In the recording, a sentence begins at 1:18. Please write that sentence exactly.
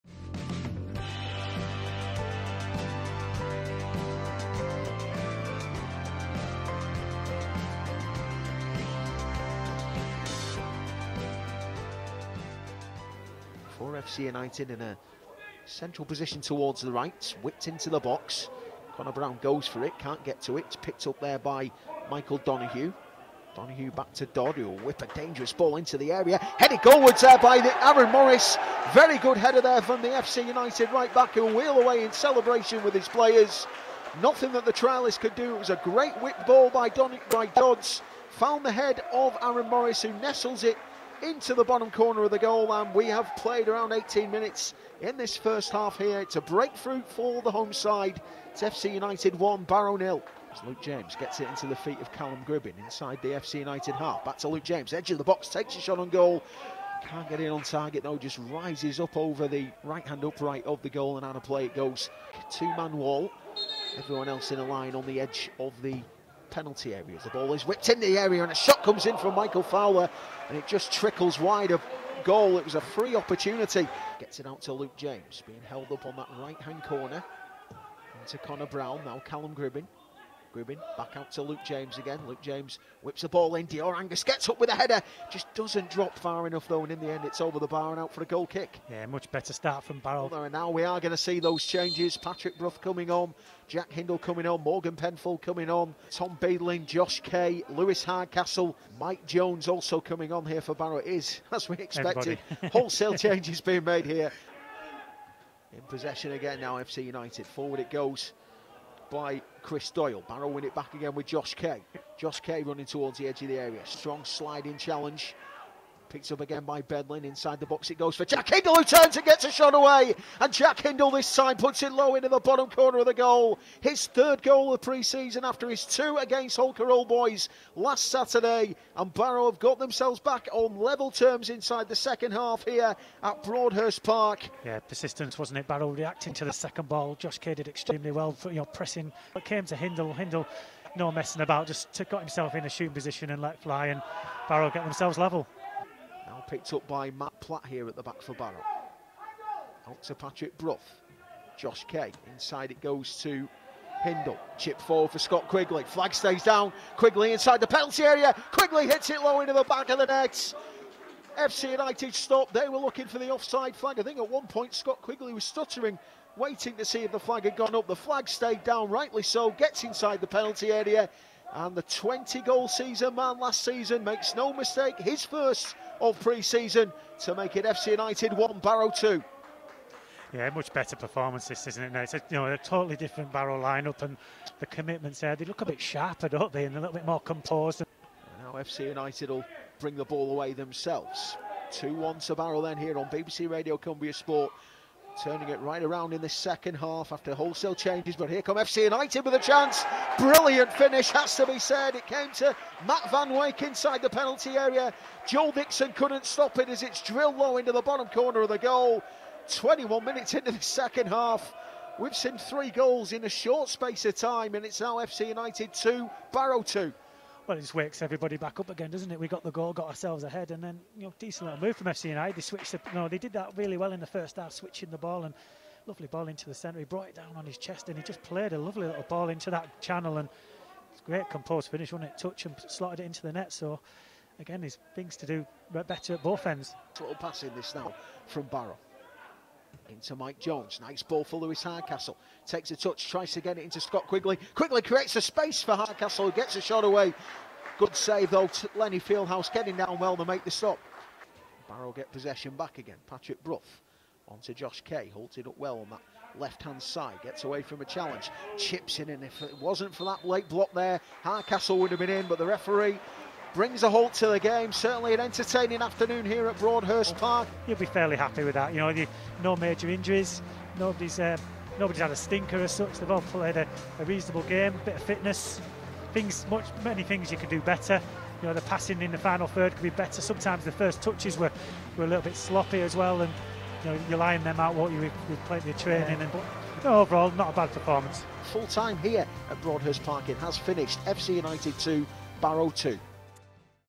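Into Connor Brown, now Callum Gribbin.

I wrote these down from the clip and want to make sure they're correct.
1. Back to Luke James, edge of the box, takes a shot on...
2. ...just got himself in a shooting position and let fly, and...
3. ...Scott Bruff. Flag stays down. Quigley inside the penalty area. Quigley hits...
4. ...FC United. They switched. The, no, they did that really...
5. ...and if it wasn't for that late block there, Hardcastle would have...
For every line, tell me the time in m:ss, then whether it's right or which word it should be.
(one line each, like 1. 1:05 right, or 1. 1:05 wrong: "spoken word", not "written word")
1. 0:54 right
2. 2:21 right
3. 2:35 wrong: "Quigley", not "Bruff"
4. 3:41 right
5. 4:19 right.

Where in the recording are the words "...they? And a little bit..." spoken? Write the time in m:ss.
3:06.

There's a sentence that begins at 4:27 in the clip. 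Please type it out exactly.
You'll be fairly happy with that.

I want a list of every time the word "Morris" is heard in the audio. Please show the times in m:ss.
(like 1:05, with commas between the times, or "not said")
0:28, 0:39.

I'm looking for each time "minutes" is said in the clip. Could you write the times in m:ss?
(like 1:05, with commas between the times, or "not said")
0:44, 3:30.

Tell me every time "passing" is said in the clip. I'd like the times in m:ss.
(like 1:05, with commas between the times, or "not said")
3:57, 4:38.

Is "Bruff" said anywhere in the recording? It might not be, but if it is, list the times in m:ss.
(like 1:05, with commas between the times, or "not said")
1:32, 2:30, 4:13.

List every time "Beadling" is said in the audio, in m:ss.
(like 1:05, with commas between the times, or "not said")
1:36, 1:56.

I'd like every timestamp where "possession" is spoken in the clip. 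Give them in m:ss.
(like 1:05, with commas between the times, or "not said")
1:45, 4:12.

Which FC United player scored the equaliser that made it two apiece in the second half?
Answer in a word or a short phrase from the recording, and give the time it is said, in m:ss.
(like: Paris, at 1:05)
Matt Van Wyk, at 3:22.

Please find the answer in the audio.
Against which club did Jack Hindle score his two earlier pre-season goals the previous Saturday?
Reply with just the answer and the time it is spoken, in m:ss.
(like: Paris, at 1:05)
Holker Old Boys, at 2:06.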